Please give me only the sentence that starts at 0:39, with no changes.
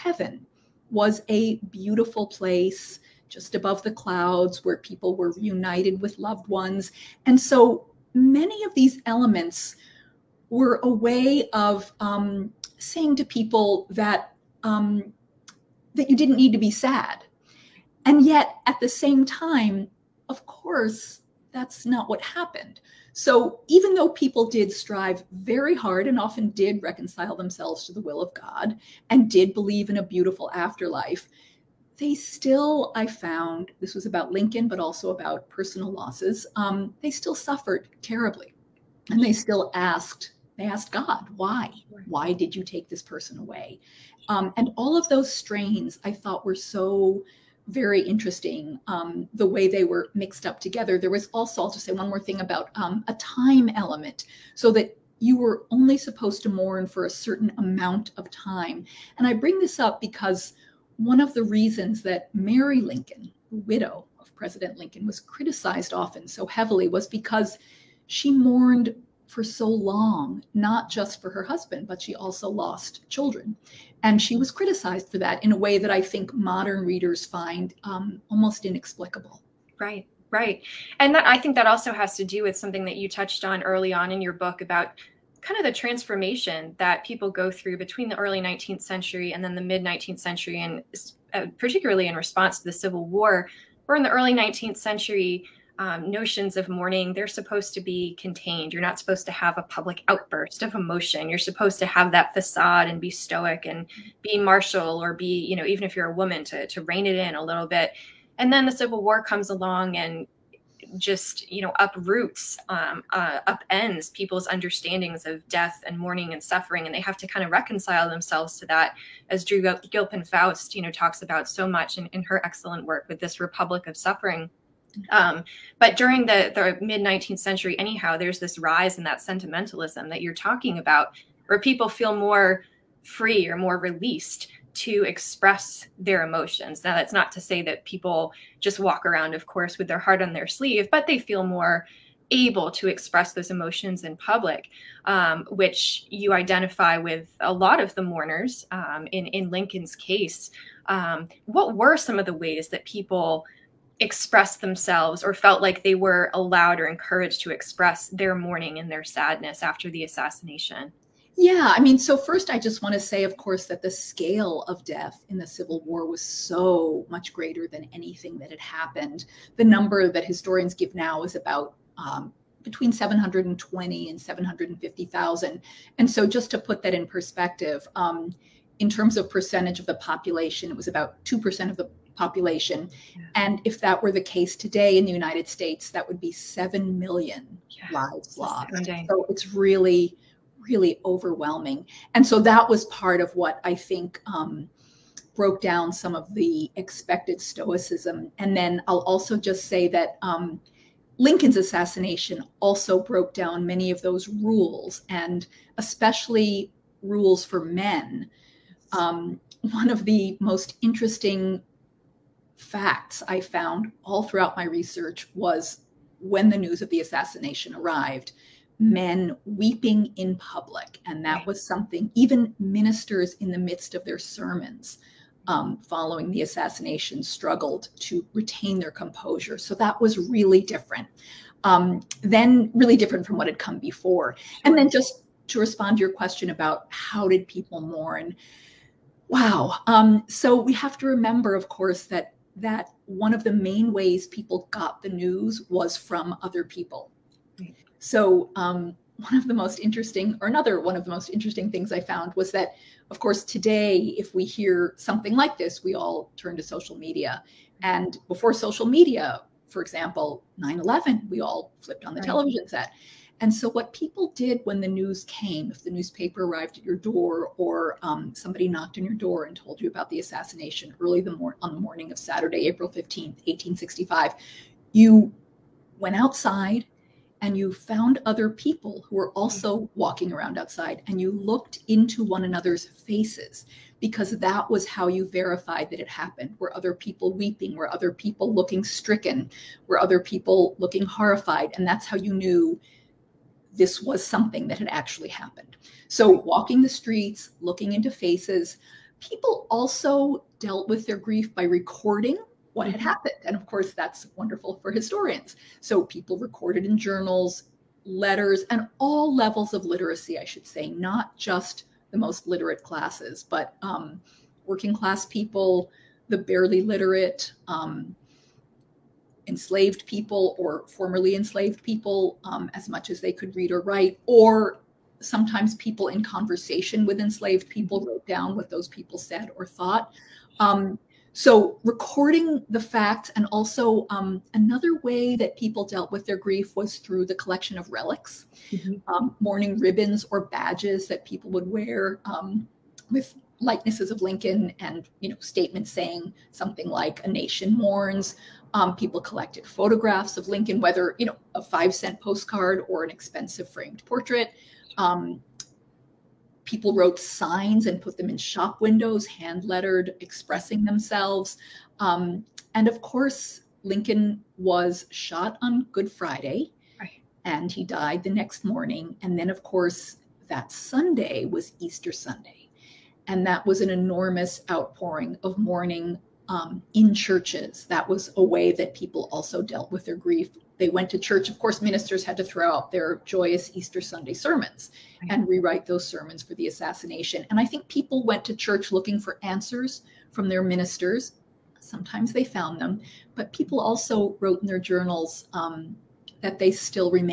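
And they still asked, they asked God, why?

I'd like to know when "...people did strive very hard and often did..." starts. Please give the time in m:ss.
0:24.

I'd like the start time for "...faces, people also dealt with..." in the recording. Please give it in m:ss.
4:58.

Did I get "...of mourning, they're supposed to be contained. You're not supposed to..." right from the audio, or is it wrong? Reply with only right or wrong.
right.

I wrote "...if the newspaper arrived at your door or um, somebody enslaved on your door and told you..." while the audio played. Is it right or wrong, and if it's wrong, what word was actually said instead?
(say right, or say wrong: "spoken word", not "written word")
wrong: "knocked", not "enslaved".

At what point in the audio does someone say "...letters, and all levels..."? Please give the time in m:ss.
5:08.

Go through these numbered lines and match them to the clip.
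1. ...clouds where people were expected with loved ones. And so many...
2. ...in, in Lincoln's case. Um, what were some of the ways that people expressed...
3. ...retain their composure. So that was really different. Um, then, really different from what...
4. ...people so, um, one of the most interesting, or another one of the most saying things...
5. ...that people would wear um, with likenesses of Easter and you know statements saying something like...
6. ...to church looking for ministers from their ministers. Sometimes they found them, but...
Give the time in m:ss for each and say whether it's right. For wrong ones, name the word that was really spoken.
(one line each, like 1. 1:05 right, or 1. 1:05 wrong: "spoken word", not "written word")
1. 0:03 wrong: "reunited", not "expected"
2. 2:29 right
3. 3:48 right
4. 4:06 wrong: "interesting", not "saying"
5. 5:41 wrong: "Lincoln", not "Easter"
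6. 6:28 wrong: "answers", not "ministers".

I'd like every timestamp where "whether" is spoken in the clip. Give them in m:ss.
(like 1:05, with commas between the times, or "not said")
5:50.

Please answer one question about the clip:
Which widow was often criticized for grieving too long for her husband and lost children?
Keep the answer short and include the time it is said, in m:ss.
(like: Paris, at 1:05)
Mary Lincoln, at 1:02.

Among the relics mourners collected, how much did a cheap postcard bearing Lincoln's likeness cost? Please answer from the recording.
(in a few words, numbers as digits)
5 cents.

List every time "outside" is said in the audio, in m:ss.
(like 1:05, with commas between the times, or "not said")
4:36, 4:40.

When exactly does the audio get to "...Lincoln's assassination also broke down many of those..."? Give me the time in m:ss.
3:21.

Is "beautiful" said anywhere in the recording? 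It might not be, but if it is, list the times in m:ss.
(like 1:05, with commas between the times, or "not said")
0:01, 0:30.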